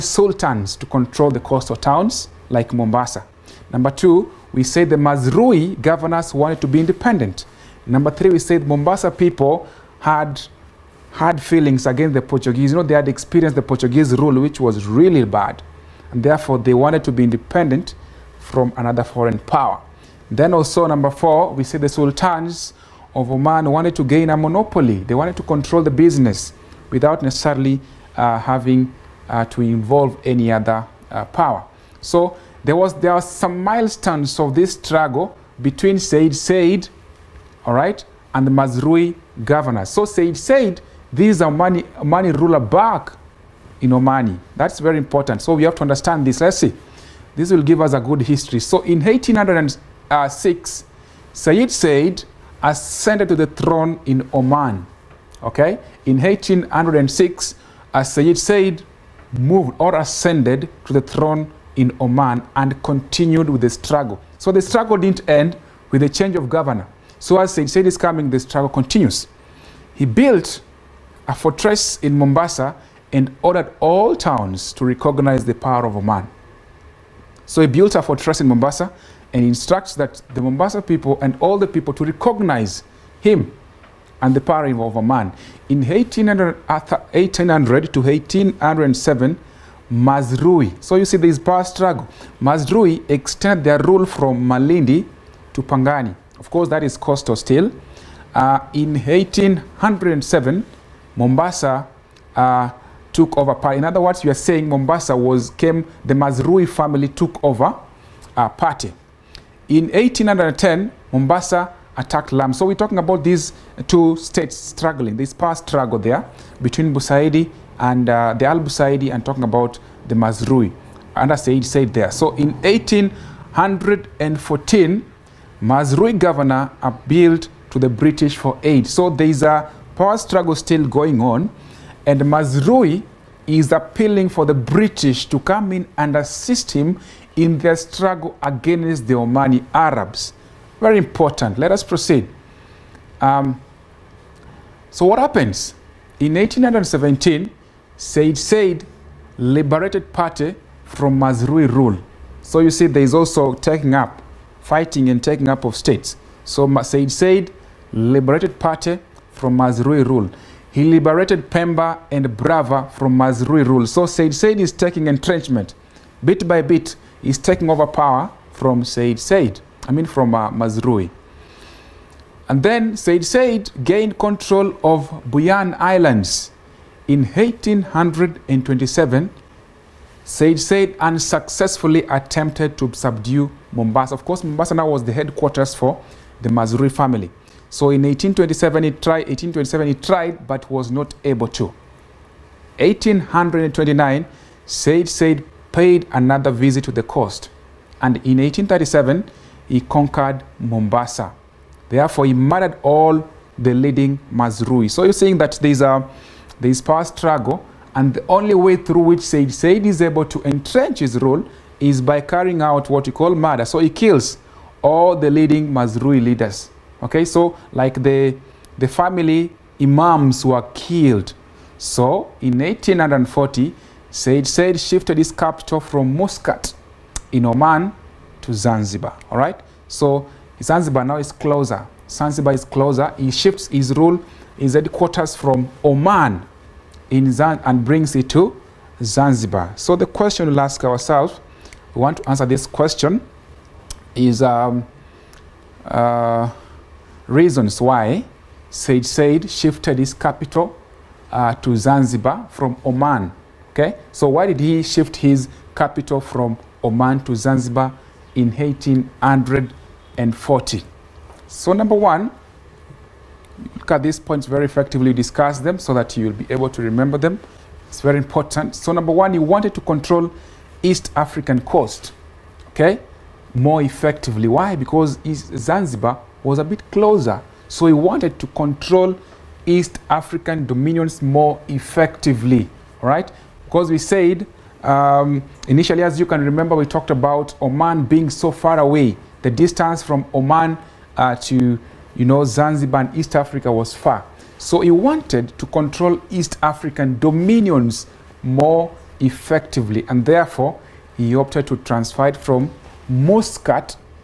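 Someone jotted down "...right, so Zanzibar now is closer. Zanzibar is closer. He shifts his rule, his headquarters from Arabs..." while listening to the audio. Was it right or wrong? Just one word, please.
wrong.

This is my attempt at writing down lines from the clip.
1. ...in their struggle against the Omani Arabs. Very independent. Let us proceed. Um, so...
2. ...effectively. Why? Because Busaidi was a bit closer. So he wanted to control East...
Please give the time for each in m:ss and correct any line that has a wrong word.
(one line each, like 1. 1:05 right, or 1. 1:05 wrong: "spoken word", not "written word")
1. 2:17 wrong: "important", not "independent"
2. 4:33 wrong: "Zanzibar", not "Busaidi".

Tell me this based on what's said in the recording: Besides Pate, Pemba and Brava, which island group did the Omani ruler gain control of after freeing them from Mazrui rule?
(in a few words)
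Bajun Islands.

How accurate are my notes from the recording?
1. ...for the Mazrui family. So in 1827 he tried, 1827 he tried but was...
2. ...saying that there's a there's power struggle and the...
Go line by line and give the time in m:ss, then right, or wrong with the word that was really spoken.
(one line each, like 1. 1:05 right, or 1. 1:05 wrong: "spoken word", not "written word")
1. 3:05 right
2. 3:25 right.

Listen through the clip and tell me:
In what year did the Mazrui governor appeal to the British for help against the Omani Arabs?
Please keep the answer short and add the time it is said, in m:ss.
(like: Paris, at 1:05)
1814, at 2:02.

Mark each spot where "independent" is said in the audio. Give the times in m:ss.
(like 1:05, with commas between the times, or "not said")
0:06, 0:17.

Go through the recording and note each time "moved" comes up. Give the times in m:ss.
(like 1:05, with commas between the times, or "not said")
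0:59.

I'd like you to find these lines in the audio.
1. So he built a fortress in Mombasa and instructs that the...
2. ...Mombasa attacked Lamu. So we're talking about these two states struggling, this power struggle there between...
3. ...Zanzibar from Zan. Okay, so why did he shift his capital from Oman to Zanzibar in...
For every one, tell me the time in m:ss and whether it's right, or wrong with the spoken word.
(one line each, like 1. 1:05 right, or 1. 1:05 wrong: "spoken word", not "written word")
1. 1:17 right
2. 1:51 right
3. 4:11 wrong: "Oman", not "Zan".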